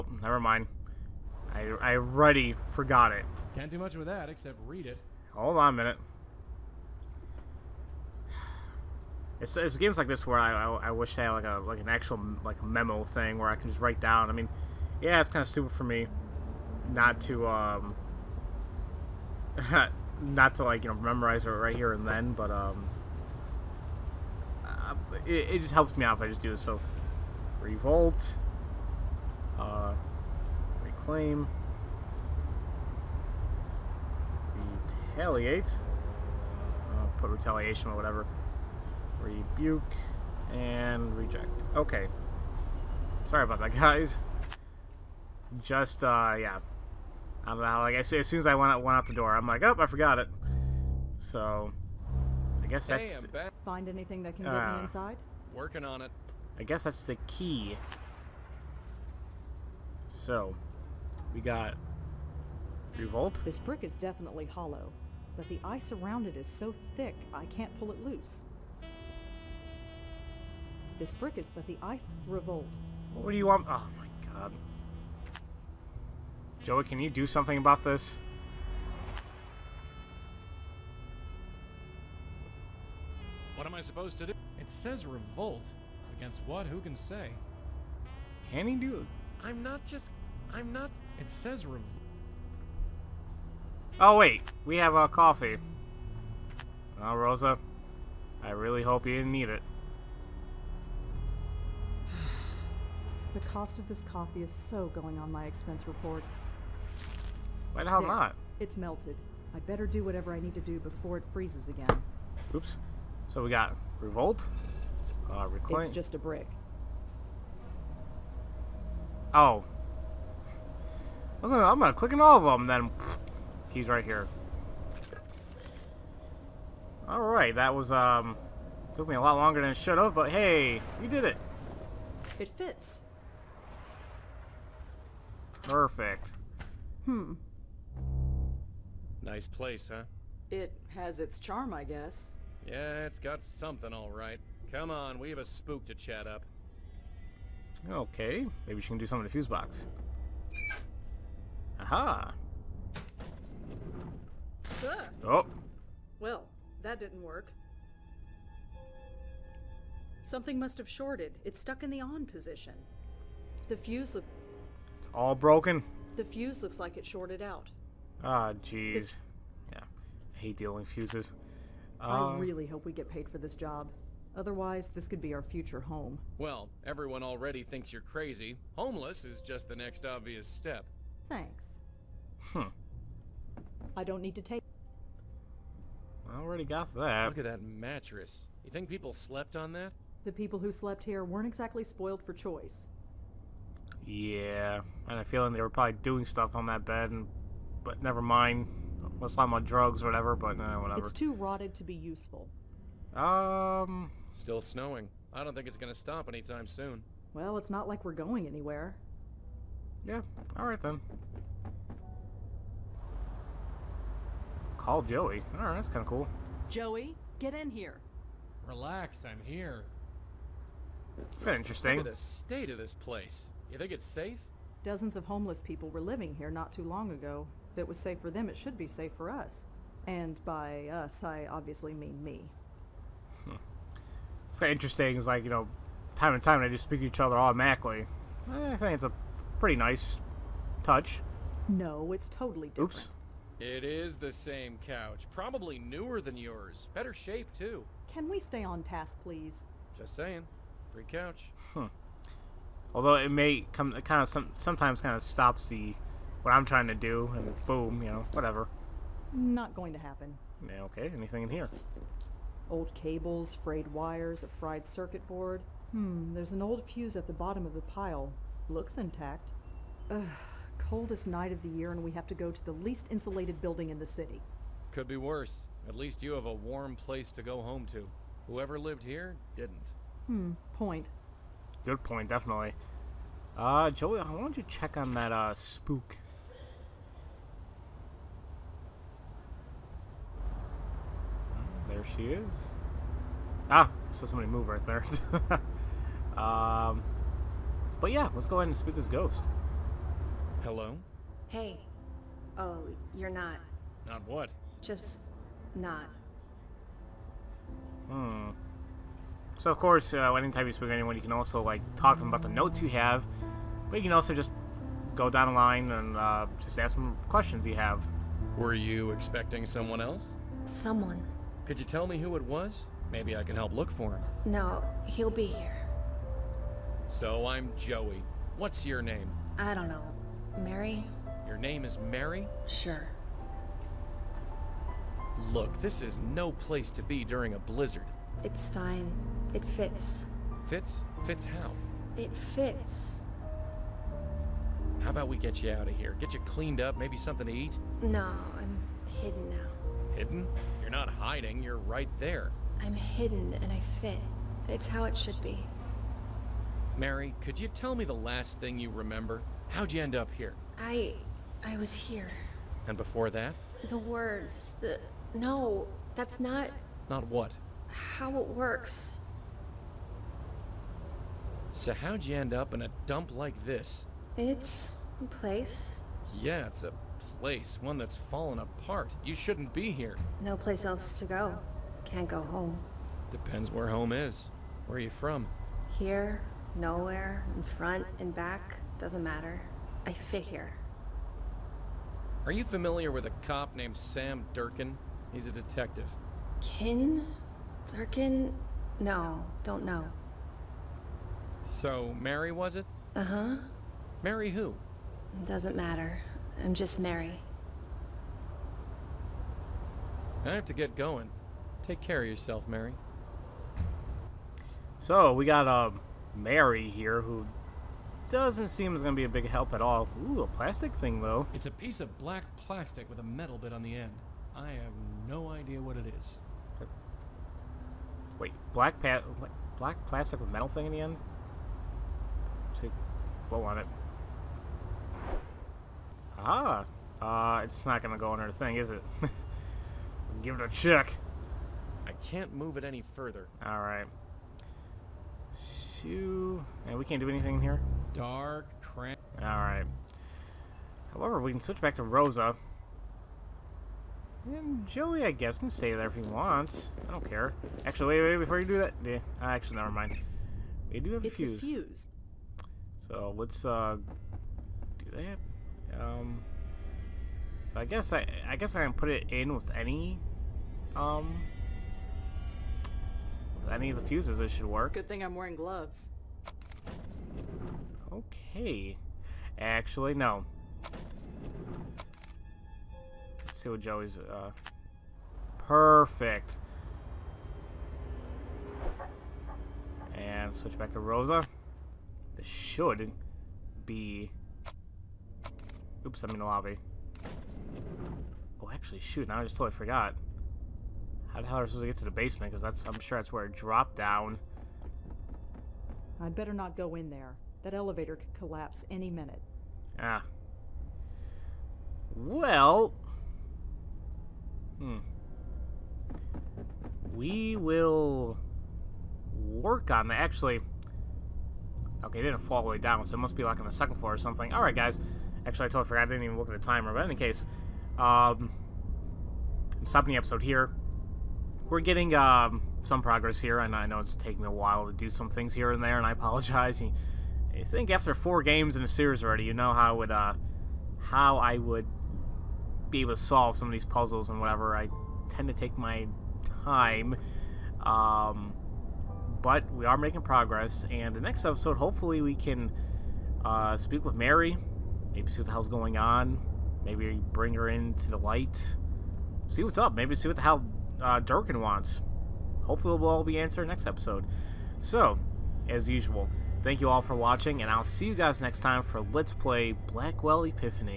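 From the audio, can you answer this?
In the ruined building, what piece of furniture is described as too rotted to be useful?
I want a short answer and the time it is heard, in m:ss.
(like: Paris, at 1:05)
mattress, at 3:07.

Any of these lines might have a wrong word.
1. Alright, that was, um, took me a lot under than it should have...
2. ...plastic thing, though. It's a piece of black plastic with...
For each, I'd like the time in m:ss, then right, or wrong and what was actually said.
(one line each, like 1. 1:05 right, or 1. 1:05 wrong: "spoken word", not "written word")
1. 2:07 wrong: "longer", not "under"
2. 7:00 right.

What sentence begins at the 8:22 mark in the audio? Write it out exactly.
Because that's I'm sure that's where it dropped down.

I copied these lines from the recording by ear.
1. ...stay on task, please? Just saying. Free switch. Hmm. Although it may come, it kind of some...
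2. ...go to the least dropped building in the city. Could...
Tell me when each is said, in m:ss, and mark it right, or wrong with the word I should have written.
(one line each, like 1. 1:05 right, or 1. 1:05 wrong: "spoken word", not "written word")
1. 4:08 wrong: "couch", not "switch"
2. 4:32 wrong: "insulated", not "dropped".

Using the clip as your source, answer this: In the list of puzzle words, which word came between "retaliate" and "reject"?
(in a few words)
rebuke.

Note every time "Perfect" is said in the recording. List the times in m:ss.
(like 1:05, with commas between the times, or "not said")
2:15, 8:05.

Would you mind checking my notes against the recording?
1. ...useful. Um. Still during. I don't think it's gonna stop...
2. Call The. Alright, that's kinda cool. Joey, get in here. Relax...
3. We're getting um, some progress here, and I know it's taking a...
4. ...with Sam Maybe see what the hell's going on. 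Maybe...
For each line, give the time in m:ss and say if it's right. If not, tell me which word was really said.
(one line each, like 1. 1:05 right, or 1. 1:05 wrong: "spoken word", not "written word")
1. 3:21 wrong: "snowing", not "during"
2. 3:34 wrong: "Joey", not "The"
3. 8:51 right
4. 9:14 wrong: "Mary", not "Sam".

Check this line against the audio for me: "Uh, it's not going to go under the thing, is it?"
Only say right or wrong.
right.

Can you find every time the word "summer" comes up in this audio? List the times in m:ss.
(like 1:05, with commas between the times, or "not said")
not said.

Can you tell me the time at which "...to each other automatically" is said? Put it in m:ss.
3:56.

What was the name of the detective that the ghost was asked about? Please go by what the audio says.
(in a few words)
Sam Durkin.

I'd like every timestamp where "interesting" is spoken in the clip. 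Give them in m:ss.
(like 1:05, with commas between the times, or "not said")
3:41, 3:54.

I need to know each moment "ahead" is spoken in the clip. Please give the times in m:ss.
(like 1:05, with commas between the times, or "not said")
4:58.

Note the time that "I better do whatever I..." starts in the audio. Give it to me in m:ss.
1:49.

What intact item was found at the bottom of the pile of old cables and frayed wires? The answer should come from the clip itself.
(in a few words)
an old fuse.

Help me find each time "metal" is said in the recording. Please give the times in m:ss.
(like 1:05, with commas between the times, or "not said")
7:03, 7:10.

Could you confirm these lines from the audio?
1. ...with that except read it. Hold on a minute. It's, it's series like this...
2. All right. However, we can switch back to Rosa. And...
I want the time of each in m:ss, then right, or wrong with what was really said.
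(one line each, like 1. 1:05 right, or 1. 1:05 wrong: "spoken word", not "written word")
1. 0:03 wrong: "games", not "series"
2. 7:29 right.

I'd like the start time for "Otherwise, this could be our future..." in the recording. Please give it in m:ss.
2:54.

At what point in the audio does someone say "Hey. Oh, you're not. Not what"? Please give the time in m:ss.
5:01.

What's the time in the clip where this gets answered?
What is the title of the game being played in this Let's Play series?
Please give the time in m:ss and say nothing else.
9:29.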